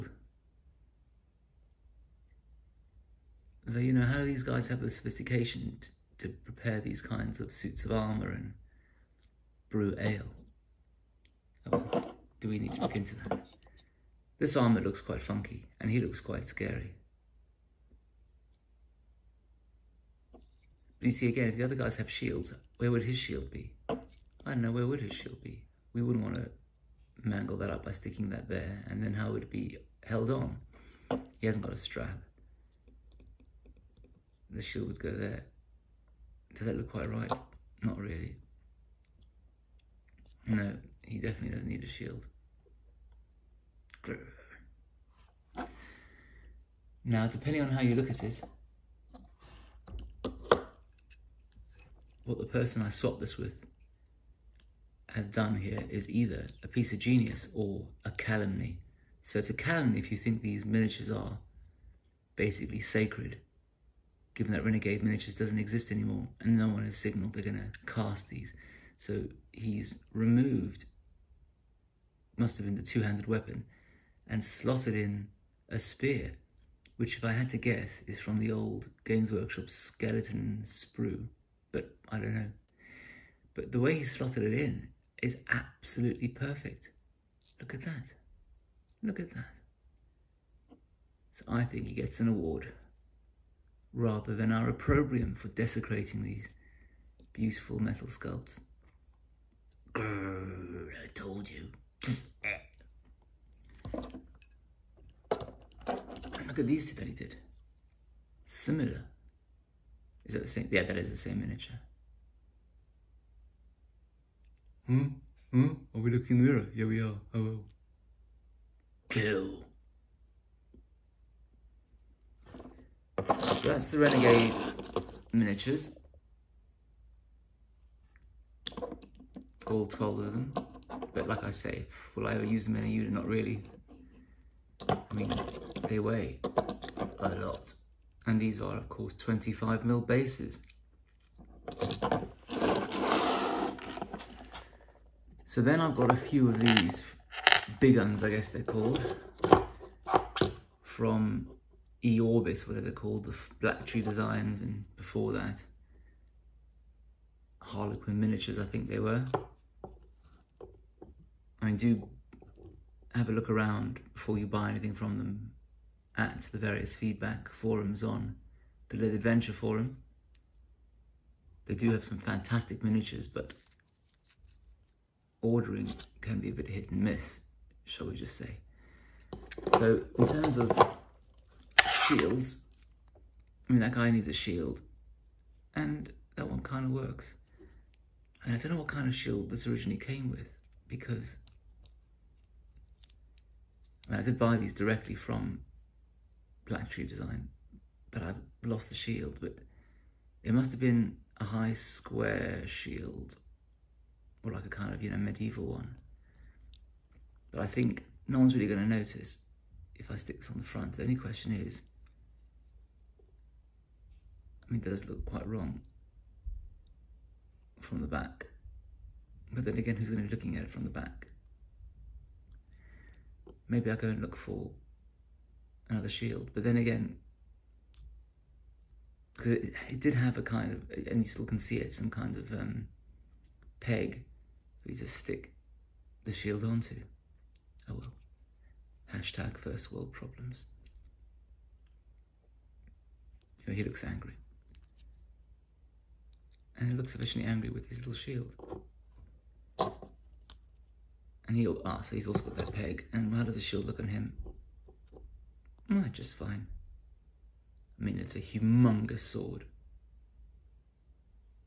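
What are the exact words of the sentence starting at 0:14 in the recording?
This armour looks quite funky, and he looks quite scary.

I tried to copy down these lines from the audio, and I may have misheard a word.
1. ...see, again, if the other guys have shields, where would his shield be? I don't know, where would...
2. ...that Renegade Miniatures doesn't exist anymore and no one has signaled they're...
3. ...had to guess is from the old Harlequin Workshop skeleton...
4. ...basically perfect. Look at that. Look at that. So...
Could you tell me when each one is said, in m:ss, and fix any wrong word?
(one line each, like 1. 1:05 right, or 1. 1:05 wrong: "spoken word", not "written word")
1. 0:21 right
2. 1:04 right
3. 1:17 wrong: "Games", not "Harlequin"
4. 1:25 wrong: "absolutely", not "basically".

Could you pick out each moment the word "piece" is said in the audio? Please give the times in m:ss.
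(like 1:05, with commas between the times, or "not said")
0:56.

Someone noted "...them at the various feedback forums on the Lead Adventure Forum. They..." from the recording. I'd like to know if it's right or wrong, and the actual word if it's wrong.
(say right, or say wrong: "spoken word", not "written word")
right.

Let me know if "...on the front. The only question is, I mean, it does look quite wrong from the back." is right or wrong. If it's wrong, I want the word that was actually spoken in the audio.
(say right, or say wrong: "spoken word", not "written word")
right.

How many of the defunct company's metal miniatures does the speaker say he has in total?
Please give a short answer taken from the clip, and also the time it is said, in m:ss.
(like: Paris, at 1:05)
12, at 2:09.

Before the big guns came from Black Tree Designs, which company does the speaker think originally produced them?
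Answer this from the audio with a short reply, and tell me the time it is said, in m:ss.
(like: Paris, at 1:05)
Harlequin Miniatures, at 2:37.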